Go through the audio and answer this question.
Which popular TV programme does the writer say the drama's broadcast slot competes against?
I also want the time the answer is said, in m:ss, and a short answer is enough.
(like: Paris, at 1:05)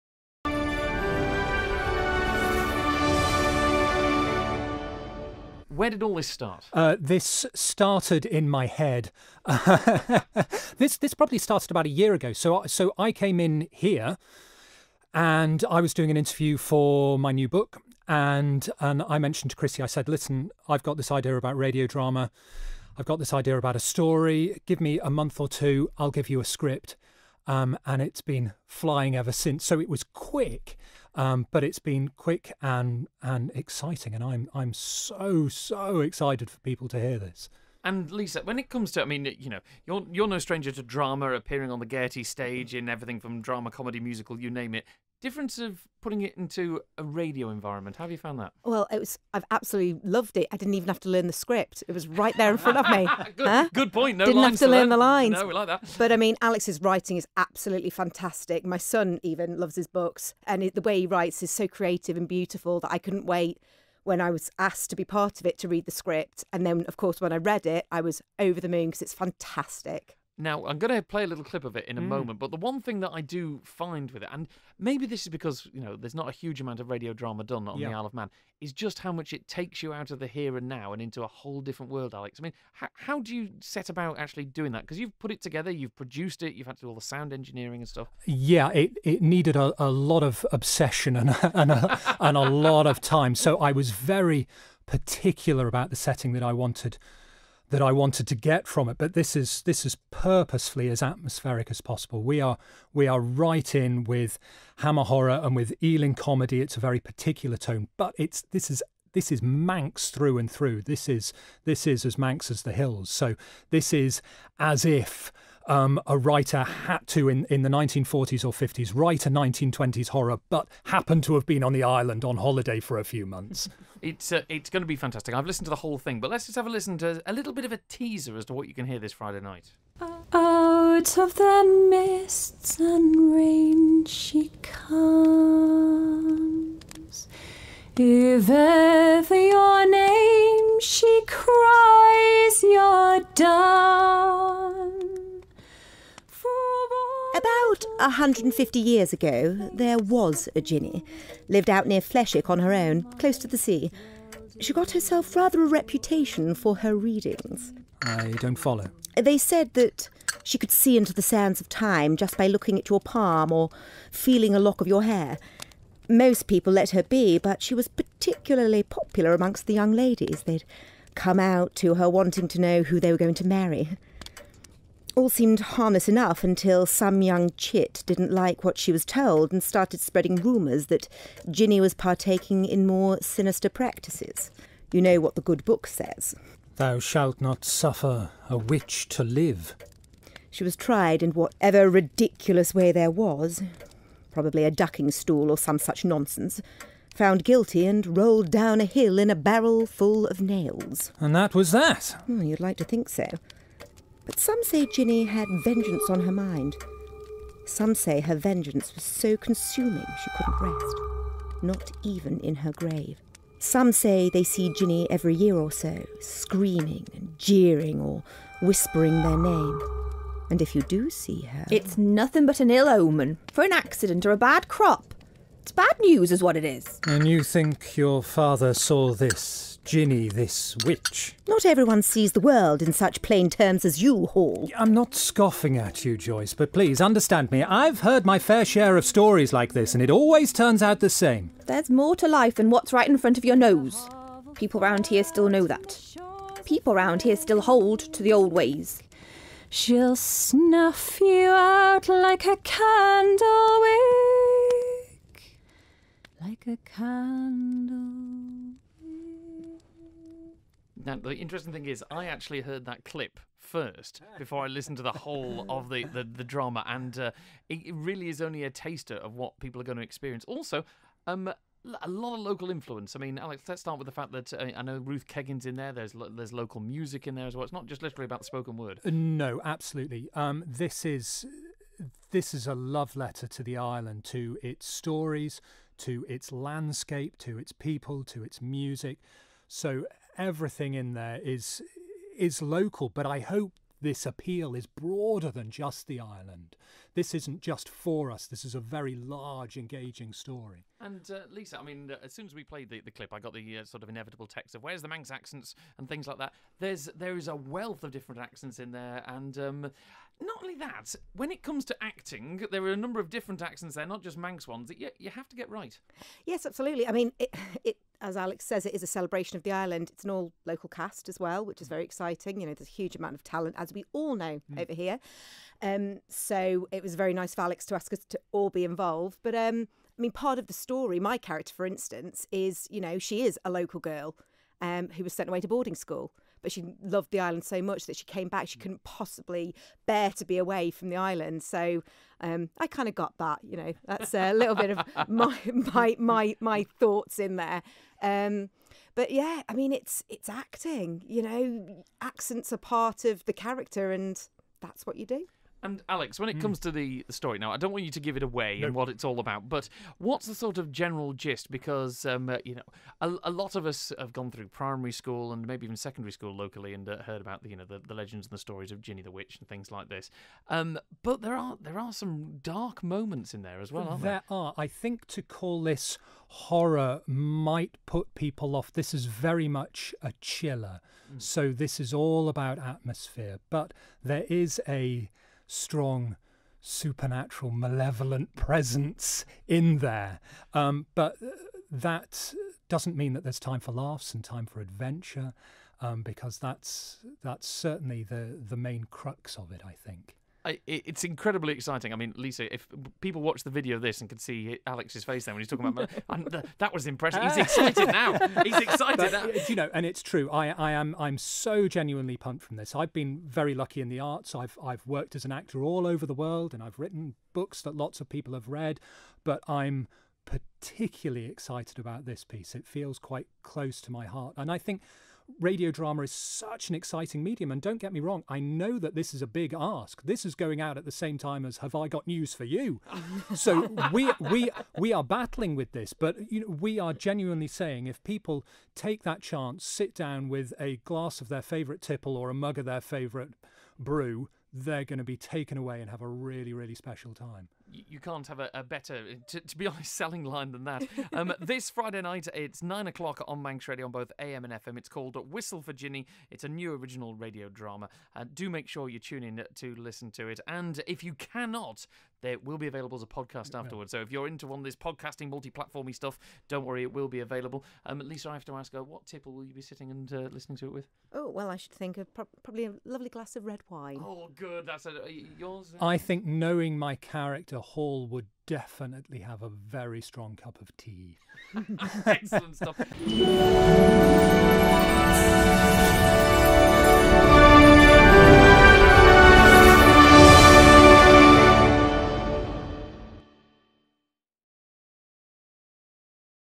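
Have I Got News for You, at 7:11.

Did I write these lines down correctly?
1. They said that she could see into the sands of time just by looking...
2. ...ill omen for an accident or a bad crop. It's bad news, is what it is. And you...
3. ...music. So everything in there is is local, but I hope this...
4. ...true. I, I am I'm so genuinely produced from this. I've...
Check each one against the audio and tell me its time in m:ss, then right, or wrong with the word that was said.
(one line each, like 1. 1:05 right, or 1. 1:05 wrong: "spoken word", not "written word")
1. 2:39 right
2. 3:42 right
3. 4:48 right
4. 6:50 wrong: "pumped", not "produced".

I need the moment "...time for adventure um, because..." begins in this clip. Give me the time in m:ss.
6:34.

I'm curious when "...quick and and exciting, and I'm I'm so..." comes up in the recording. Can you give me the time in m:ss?
0:32.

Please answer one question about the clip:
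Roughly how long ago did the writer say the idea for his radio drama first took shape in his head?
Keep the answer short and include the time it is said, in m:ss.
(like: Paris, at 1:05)
about a year ago, at 0:11.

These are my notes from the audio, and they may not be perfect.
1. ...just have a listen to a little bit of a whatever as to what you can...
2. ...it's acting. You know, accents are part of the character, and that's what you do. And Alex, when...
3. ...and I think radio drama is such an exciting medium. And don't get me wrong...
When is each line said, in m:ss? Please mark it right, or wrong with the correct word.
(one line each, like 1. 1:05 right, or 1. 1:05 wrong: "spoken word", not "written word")
1. 2:06 wrong: "teaser", not "whatever"
2. 5:50 right
3. 7:04 right.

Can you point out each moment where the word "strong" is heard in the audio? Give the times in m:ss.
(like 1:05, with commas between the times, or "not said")
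6:25, 8:00.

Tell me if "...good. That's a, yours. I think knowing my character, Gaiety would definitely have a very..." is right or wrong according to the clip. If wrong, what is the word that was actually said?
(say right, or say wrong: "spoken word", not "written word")
wrong: "Hall", not "Gaiety".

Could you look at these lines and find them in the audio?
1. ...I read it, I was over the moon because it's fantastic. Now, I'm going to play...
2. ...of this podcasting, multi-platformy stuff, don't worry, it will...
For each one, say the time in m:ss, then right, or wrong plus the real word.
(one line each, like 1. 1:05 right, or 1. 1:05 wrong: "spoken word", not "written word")
1. 1:07 right
2. 7:44 right.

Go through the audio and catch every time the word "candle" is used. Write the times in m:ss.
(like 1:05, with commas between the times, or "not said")
4:12, 4:16.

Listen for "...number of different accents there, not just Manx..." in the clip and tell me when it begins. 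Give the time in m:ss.
5:12.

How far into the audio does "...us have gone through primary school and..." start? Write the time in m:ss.
6:03.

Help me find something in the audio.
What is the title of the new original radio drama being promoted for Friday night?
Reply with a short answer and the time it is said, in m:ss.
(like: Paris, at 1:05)
Whistle for Jinny, at 7:35.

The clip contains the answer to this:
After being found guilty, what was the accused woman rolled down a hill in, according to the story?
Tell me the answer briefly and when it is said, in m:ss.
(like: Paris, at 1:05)
a barrel full of nails, at 3:19.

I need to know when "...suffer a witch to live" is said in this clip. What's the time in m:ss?
3:07.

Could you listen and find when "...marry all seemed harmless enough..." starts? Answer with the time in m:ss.
2:53.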